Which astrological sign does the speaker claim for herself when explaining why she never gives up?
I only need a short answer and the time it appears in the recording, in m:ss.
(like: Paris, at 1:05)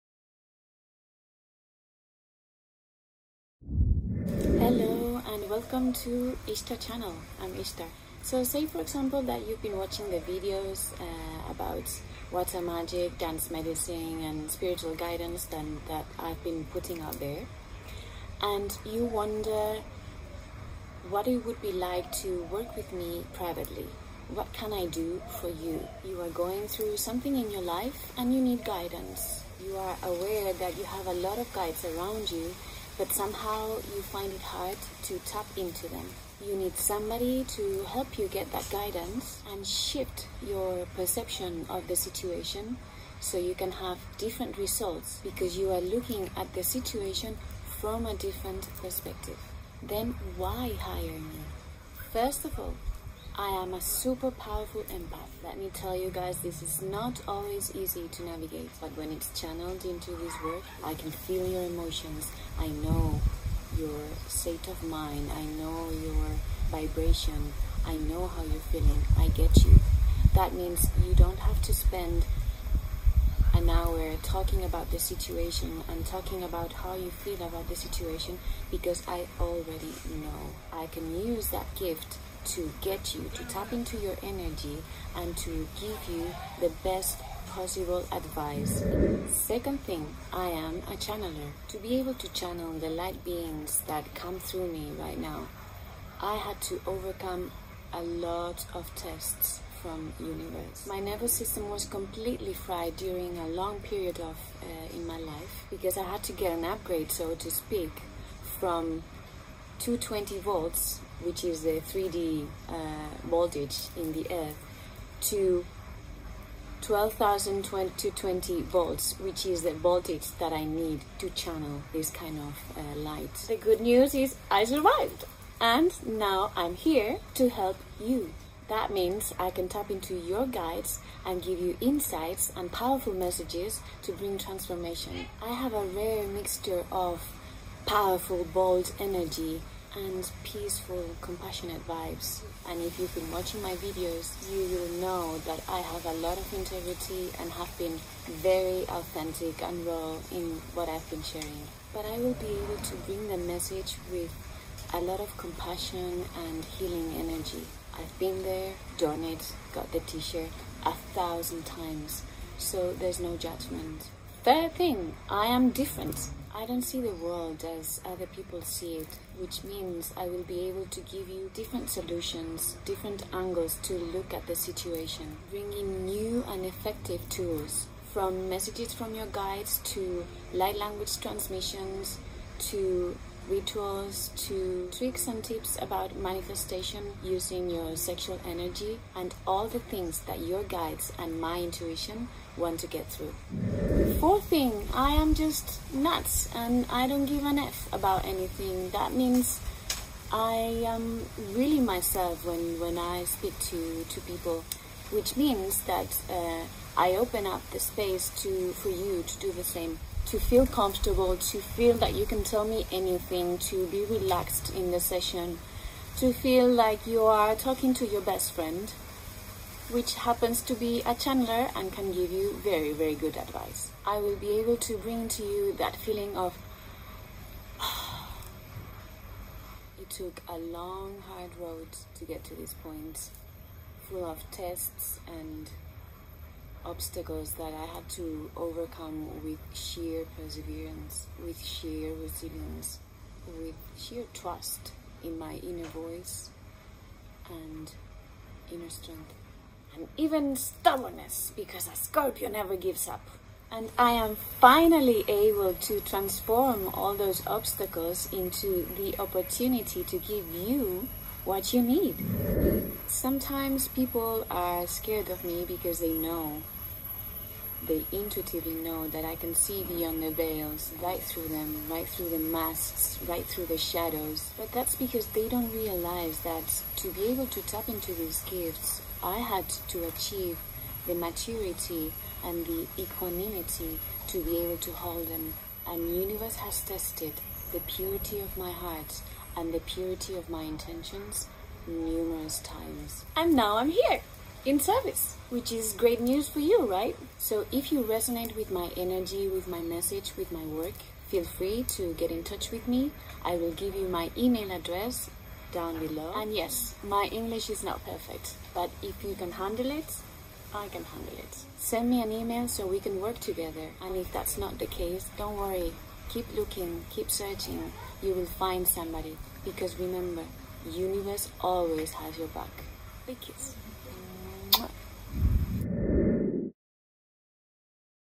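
Scorpio, at 4:11.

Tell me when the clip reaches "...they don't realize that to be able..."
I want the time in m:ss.
4:35.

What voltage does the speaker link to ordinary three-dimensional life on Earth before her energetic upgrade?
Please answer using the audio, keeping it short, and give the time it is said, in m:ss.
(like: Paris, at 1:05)
220 volts, at 1:49.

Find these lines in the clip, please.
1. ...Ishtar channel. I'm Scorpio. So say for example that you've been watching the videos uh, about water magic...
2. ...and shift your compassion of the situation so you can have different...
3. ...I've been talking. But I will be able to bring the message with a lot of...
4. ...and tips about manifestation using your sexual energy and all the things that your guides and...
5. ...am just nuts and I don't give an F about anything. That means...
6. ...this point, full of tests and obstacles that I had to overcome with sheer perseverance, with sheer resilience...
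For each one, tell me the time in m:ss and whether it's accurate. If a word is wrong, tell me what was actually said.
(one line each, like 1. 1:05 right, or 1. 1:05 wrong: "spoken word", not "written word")
1. 0:06 wrong: "Ishtar", not "Scorpio"
2. 0:39 wrong: "perception", not "compassion"
3. 2:30 wrong: "sharing", not "talking"
4. 3:05 right
5. 3:15 right
6. 3:52 right.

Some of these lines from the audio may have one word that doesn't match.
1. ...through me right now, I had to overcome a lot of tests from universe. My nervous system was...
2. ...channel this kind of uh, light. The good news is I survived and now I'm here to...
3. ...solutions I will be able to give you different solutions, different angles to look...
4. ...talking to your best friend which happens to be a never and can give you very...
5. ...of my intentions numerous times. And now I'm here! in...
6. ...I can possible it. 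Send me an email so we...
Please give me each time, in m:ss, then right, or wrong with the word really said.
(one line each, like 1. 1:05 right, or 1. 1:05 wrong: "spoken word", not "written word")
1. 1:34 right
2. 2:01 right
3. 2:49 wrong: "means", not "solutions"
4. 3:37 wrong: "channeler", not "never"
5. 4:50 right
6. 5:10 wrong: "handle", not "possible".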